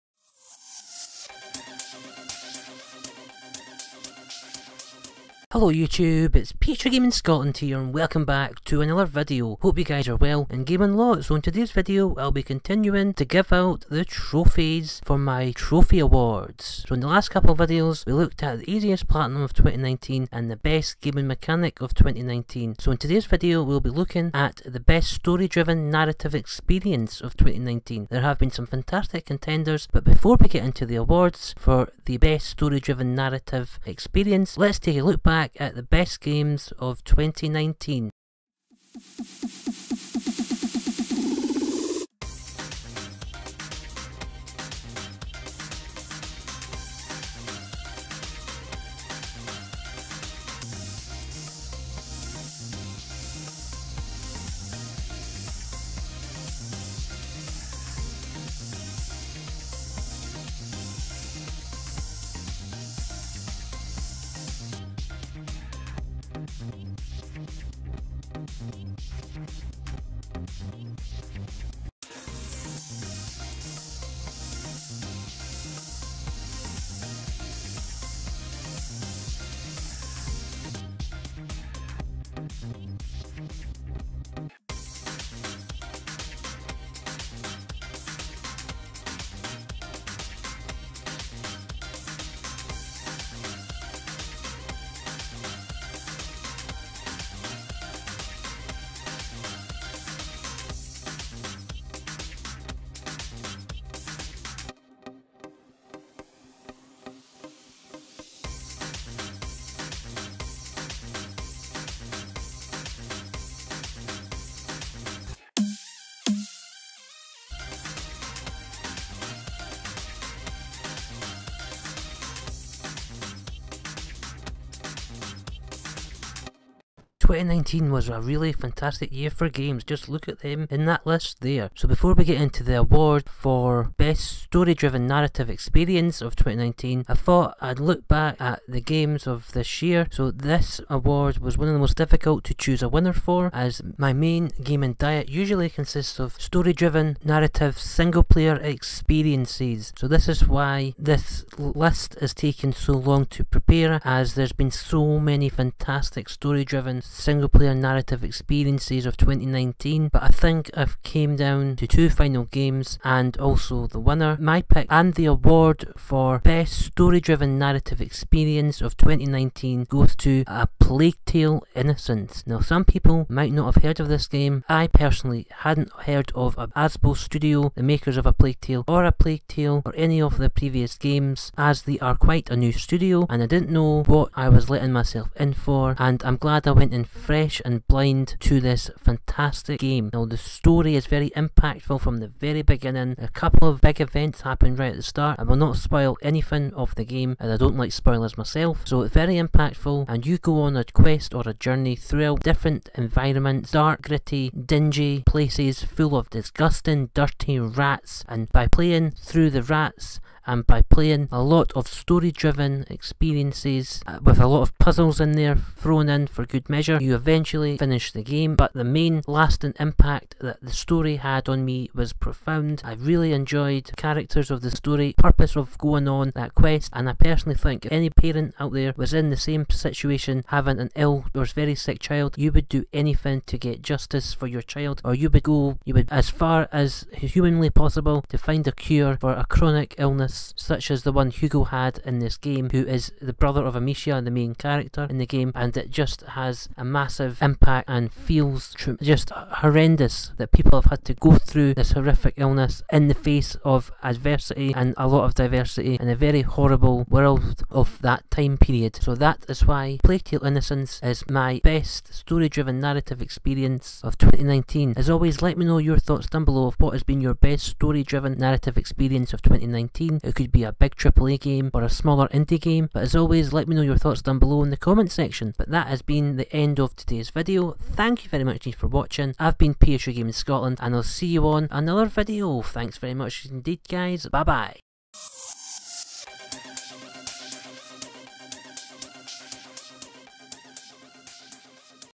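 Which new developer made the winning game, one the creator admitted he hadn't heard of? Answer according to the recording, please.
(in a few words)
Asobo Studio.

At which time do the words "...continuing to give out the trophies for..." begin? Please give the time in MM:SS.
00:12.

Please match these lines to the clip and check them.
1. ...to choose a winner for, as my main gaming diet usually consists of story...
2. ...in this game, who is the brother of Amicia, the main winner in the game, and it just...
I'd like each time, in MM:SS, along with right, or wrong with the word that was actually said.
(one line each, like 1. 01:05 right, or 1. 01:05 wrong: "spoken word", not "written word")
1. 02:22 right
2. 04:02 wrong: "character", not "winner".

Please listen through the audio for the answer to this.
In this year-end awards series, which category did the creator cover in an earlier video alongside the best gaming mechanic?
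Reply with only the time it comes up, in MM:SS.
00:18.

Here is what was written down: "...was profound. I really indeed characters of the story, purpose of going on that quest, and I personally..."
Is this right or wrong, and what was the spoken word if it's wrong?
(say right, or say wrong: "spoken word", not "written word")
wrong: "enjoyed", not "indeed".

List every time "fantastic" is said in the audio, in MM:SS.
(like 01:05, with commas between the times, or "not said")
00:28, 02:08, 02:35, 03:08.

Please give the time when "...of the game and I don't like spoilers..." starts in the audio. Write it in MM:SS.
03:16.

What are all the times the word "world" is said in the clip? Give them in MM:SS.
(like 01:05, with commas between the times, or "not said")
04:17.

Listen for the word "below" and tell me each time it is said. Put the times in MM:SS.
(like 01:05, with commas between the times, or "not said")
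04:26, 04:34.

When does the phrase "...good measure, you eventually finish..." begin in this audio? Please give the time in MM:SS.
03:36.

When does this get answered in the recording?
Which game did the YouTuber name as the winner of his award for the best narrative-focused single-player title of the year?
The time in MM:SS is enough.
02:50.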